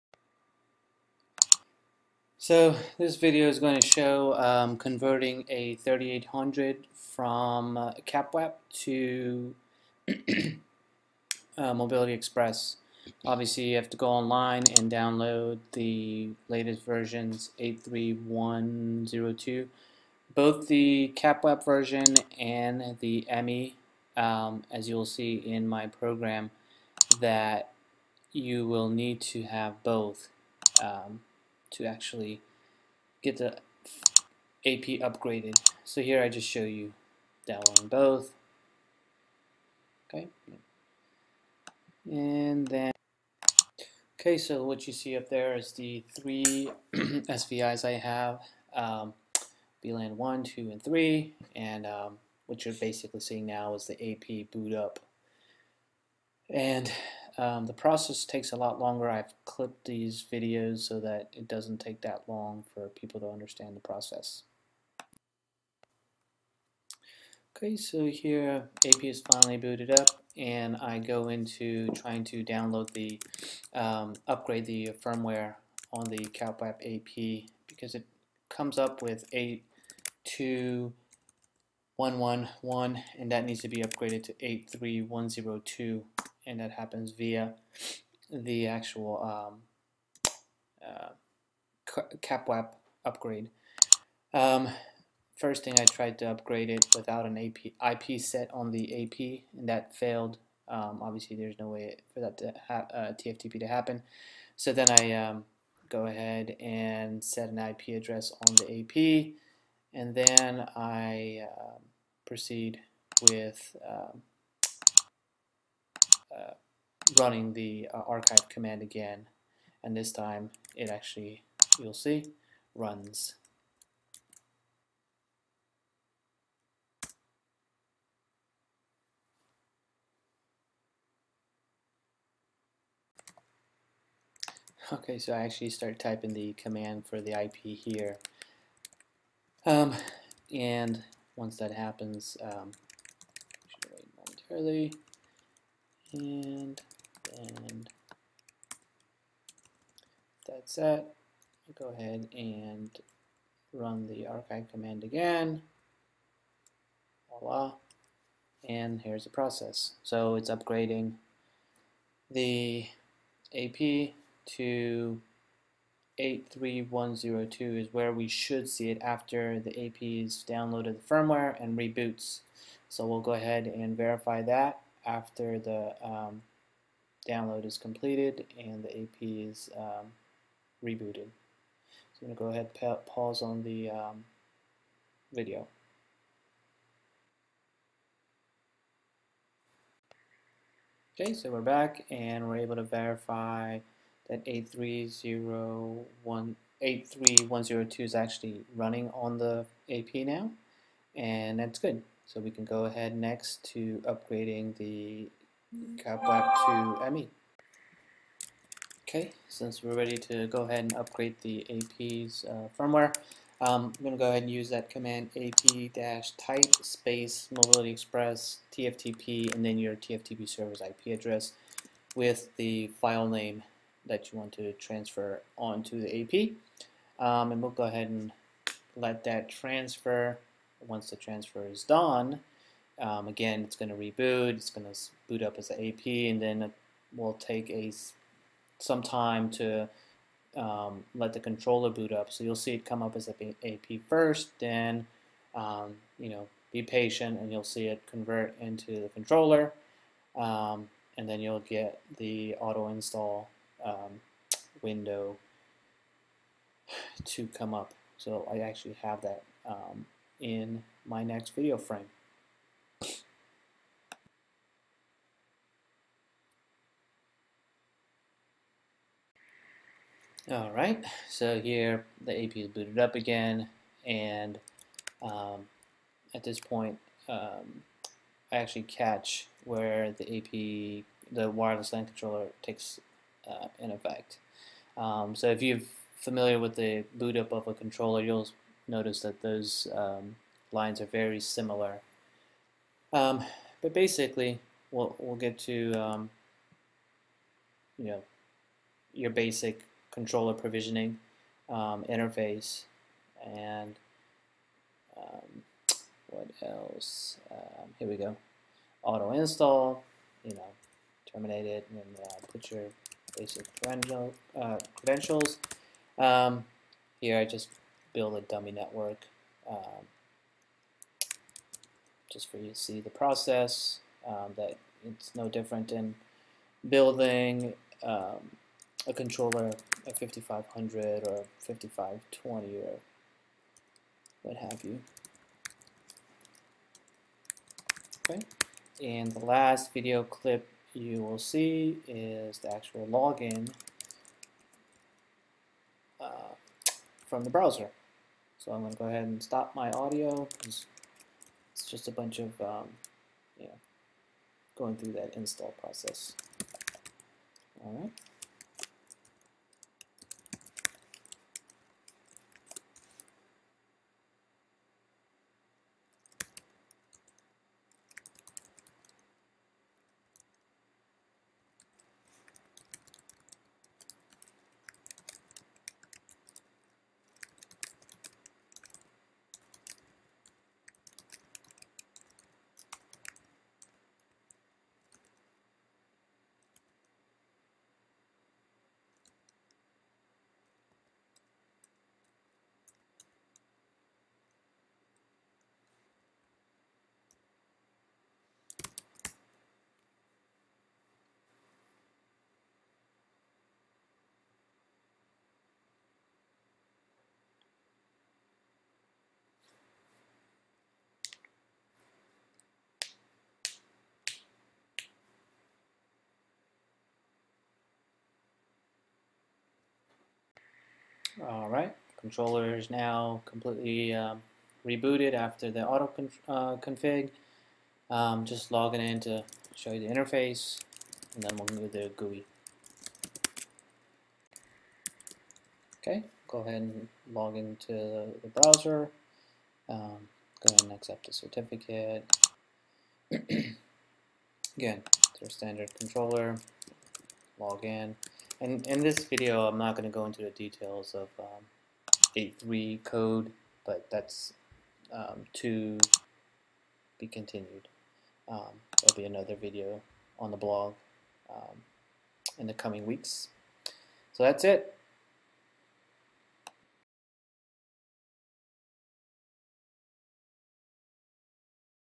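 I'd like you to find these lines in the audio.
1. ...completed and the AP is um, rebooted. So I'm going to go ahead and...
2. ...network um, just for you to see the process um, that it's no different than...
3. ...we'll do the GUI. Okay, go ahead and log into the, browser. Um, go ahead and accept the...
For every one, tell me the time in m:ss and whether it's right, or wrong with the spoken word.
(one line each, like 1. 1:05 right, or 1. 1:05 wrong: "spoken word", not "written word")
1. 2:57 right
2. 5:18 right
3. 7:11 right.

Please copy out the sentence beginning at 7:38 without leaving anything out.
Um, there'll be another video on the blog um, in the coming weeks.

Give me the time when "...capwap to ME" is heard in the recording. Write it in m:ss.
3:25.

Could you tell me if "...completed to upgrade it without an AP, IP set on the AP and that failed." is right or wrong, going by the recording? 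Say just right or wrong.
wrong.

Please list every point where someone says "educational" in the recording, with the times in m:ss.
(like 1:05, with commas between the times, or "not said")
not said.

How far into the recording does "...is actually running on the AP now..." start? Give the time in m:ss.
3:18.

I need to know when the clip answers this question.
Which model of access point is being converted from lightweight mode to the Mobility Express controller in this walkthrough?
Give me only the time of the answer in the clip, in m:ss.
0:05.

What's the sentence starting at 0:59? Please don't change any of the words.
I've clipped these videos so that it doesn't take that long for people to understand the process.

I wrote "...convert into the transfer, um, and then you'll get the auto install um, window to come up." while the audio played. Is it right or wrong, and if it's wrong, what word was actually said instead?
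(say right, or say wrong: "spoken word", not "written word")
wrong: "controller", not "transfer".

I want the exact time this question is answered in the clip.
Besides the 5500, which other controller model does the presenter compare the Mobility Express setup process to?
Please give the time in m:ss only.
5:31.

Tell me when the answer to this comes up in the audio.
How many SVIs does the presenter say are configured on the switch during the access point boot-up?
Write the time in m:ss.
0:46.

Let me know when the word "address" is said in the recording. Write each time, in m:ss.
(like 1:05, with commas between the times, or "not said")
1:48, 3:41.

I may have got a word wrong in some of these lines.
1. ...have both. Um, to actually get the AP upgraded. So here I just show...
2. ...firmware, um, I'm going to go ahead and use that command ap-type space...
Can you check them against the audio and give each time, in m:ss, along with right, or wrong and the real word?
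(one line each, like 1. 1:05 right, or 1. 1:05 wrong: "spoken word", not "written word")
1. 0:29 right
2. 3:32 right.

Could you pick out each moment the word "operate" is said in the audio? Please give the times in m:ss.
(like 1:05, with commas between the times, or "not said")
not said.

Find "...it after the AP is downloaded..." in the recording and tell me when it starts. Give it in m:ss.
2:48.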